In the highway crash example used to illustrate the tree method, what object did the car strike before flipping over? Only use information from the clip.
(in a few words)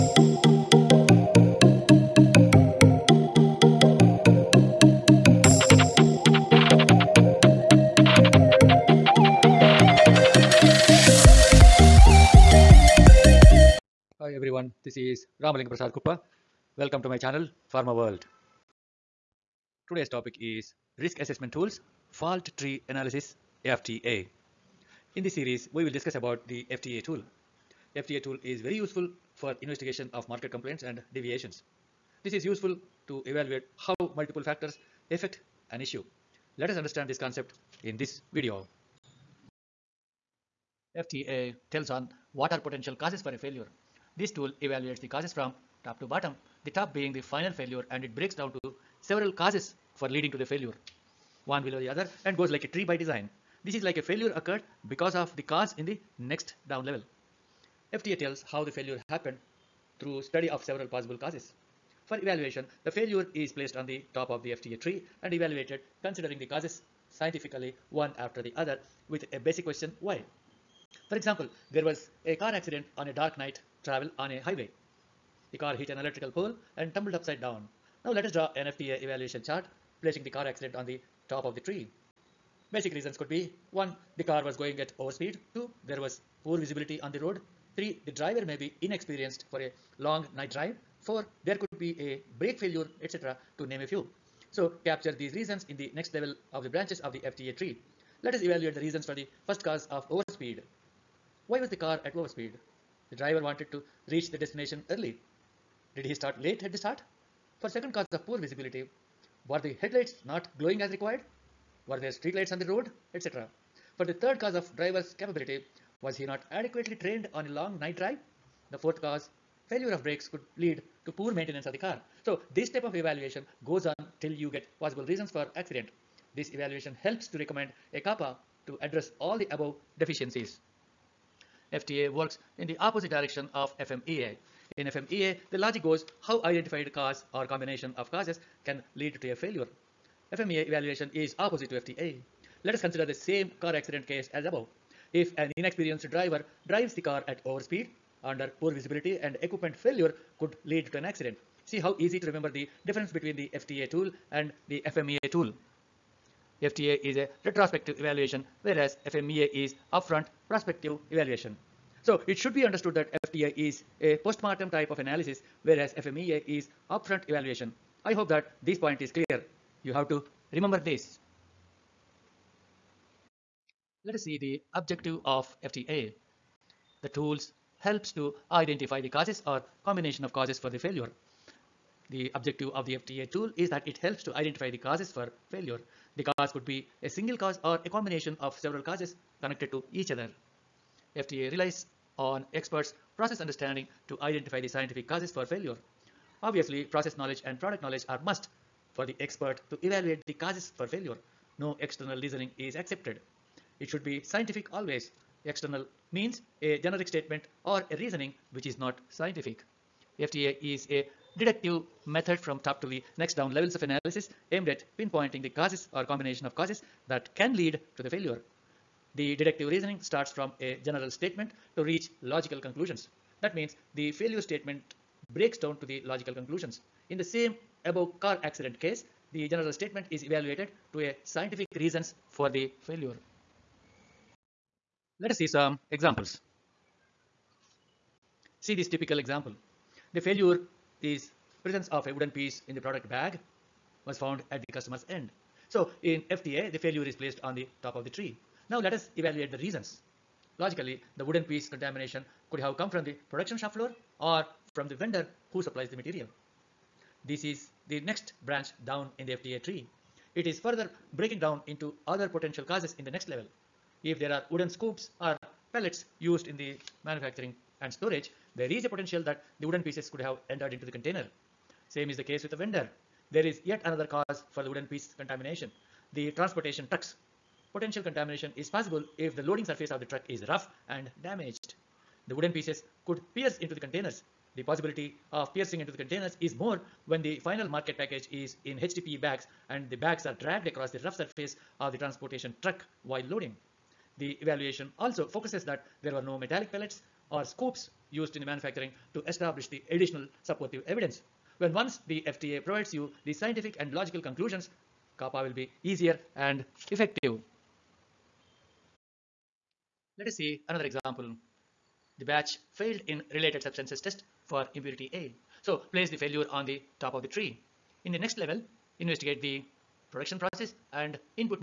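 An electrical pole.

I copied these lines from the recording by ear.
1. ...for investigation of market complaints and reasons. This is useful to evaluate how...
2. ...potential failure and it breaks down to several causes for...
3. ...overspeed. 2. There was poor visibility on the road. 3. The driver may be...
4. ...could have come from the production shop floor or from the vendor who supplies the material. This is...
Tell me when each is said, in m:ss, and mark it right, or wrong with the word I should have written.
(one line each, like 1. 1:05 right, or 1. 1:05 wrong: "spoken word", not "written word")
1. 0:29 wrong: "deviations", not "reasons"
2. 0:47 wrong: "final", not "potential"
3. 1:24 right
4. 4:12 right.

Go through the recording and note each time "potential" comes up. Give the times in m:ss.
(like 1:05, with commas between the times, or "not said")
0:42, 4:22, 4:28, 4:37.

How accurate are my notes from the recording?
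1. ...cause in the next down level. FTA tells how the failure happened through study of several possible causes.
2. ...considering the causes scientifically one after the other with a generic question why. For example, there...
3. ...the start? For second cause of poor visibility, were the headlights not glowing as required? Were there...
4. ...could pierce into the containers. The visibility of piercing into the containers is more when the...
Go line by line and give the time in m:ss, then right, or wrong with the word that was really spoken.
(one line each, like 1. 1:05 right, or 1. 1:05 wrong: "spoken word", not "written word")
1. 0:55 right
2. 1:06 wrong: "basic", not "generic"
3. 1:46 right
4. 4:43 wrong: "possibility", not "visibility".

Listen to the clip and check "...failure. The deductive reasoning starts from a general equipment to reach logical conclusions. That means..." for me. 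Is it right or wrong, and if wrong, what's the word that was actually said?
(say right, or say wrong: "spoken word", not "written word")
wrong: "statement", not "equipment".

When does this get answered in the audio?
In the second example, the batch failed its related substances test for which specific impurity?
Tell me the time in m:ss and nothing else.
5:14.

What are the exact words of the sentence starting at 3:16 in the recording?
Obviously, process knowledge and product knowledge are must for the expert to evaluate the causes for failure.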